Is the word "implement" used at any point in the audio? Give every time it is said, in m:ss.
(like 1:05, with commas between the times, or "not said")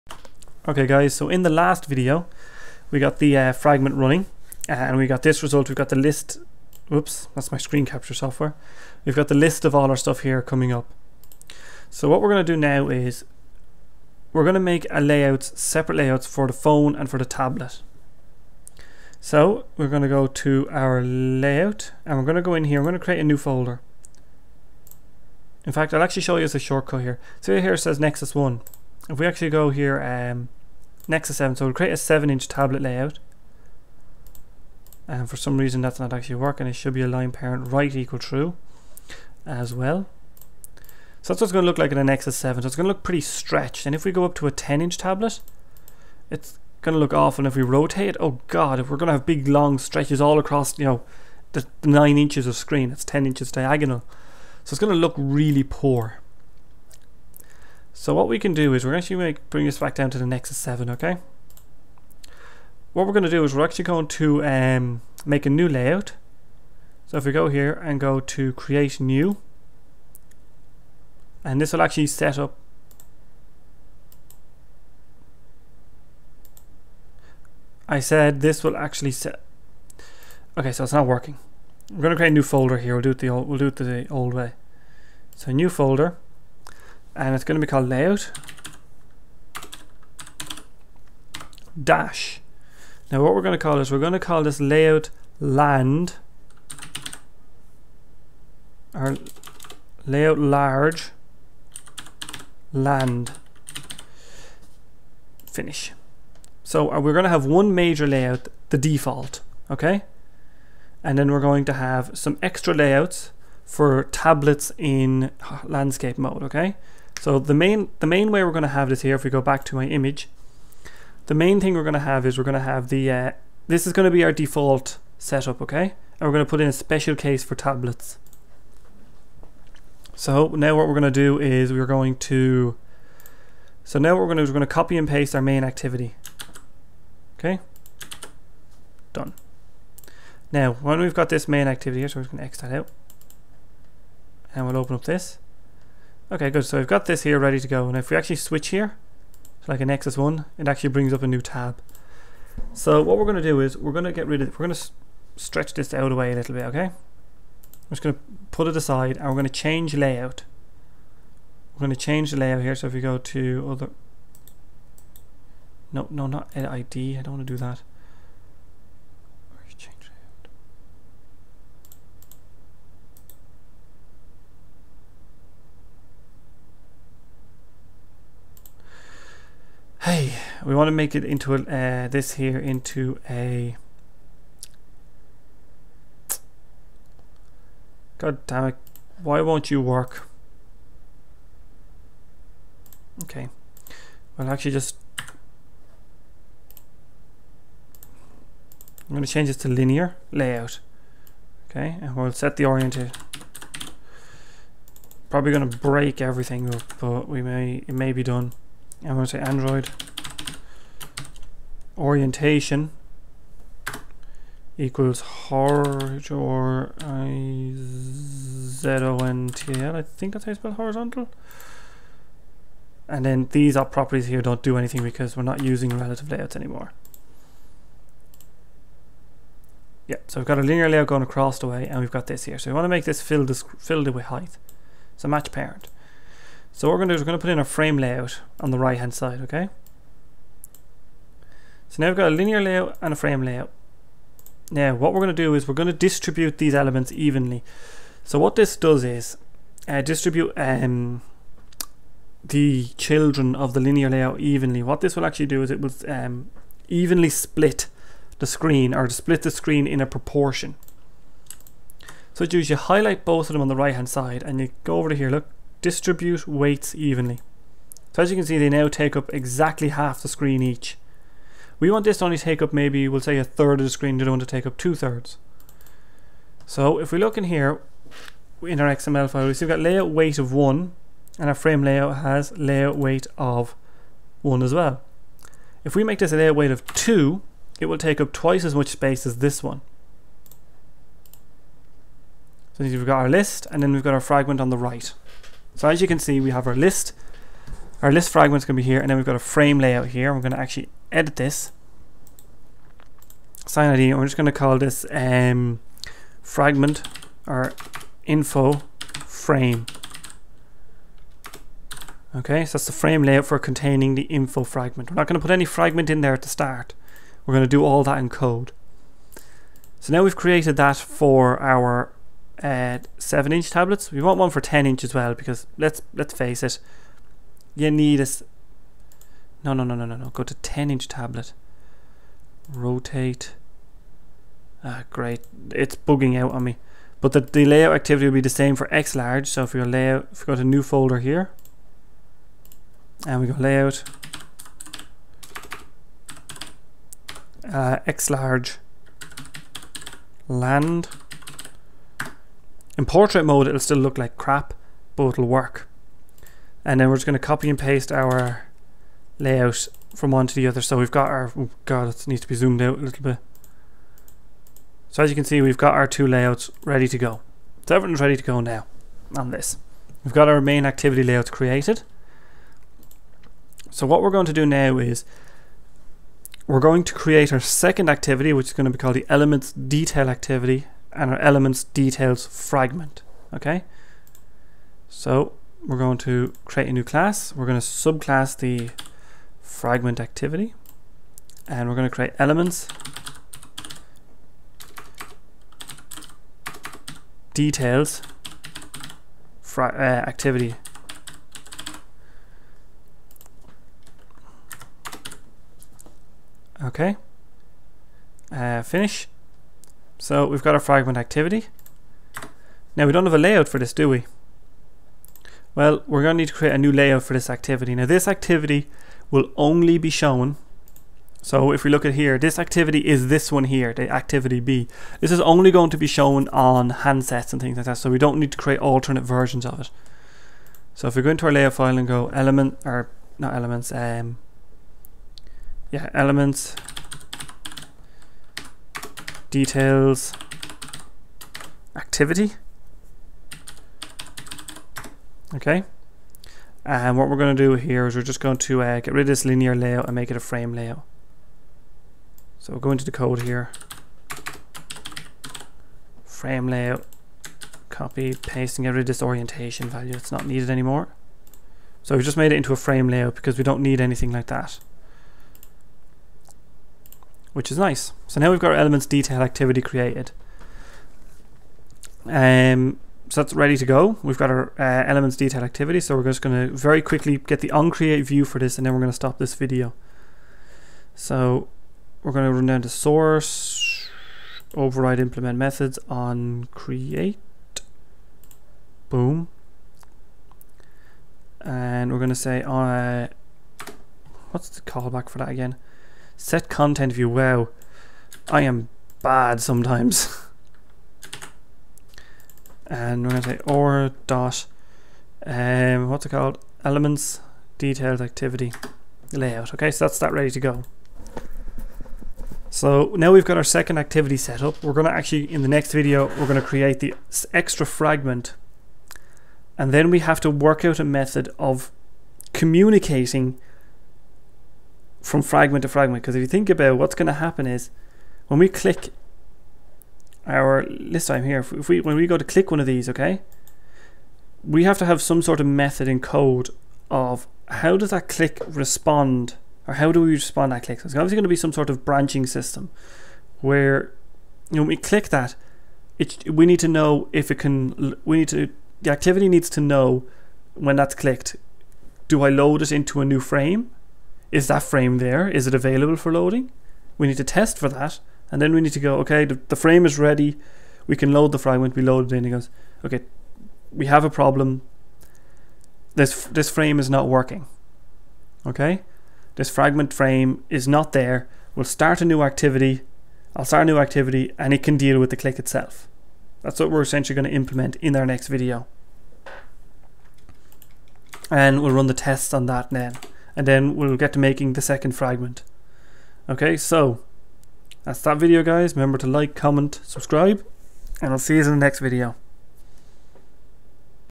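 8:05, 9:37.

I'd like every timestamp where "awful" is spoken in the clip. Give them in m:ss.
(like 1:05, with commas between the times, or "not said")
0:47.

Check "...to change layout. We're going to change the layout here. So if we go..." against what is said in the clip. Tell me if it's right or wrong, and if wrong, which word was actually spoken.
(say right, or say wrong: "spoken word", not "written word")
right.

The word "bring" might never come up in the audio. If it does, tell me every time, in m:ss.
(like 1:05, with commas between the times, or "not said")
0:59, 2:30.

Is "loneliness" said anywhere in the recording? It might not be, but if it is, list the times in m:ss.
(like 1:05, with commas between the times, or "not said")
not said.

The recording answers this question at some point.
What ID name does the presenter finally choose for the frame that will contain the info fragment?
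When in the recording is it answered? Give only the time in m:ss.
5:08.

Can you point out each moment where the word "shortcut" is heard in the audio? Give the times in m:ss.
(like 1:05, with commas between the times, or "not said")
0:26.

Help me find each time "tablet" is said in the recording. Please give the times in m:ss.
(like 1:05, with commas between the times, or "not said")
0:17, 0:32, 0:44, 1:54, 2:07, 5:23, 5:31.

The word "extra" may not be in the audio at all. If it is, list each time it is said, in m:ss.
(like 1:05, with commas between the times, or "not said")
1:52, 8:37.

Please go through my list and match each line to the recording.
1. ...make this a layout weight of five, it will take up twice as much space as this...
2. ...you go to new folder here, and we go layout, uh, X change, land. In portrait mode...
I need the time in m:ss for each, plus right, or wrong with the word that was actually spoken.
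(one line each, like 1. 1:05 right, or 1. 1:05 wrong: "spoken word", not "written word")
1. 4:46 wrong: "two", not "five"
2. 5:40 wrong: "large", not "change".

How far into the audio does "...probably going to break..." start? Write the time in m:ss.
3:25.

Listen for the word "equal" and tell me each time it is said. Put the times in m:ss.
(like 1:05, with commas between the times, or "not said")
0:37, 3:34.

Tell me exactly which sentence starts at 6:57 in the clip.
Now this activity will only be shown.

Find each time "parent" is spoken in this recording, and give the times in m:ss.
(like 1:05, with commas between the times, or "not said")
0:37, 3:55.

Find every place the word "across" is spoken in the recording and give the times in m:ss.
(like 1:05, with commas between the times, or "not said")
0:50, 3:51.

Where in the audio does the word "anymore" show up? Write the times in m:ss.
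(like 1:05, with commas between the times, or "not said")
3:46, 7:40.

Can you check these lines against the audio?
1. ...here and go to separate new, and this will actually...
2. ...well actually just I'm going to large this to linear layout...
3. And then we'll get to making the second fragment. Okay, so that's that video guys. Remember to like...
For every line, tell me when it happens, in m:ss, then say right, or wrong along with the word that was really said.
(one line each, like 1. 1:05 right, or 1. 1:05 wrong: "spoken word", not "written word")
1. 1:07 wrong: "create", not "separate"
2. 3:14 wrong: "change", not "large"
3. 9:43 right.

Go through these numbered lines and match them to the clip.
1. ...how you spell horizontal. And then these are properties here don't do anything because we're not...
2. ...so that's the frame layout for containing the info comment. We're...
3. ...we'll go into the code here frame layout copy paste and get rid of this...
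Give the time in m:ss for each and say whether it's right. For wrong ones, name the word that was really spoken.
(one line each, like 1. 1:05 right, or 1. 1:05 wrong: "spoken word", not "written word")
1. 3:40 right
2. 5:12 wrong: "fragment", not "comment"
3. 7:32 right.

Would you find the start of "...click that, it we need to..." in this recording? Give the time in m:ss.
9:04.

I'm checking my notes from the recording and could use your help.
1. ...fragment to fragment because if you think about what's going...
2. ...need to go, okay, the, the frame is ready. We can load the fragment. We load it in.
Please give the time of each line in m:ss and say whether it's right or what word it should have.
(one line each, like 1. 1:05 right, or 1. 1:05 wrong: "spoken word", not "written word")
1. 8:45 right
2. 9:18 right.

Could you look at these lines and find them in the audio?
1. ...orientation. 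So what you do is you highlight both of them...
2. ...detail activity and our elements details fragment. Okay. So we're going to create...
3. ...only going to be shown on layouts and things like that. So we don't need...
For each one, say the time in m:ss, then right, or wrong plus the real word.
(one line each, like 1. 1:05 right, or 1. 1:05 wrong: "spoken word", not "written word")
1. 4:20 wrong: "proportion", not "orientation"
2. 6:19 right
3. 7:05 wrong: "handsets", not "layouts".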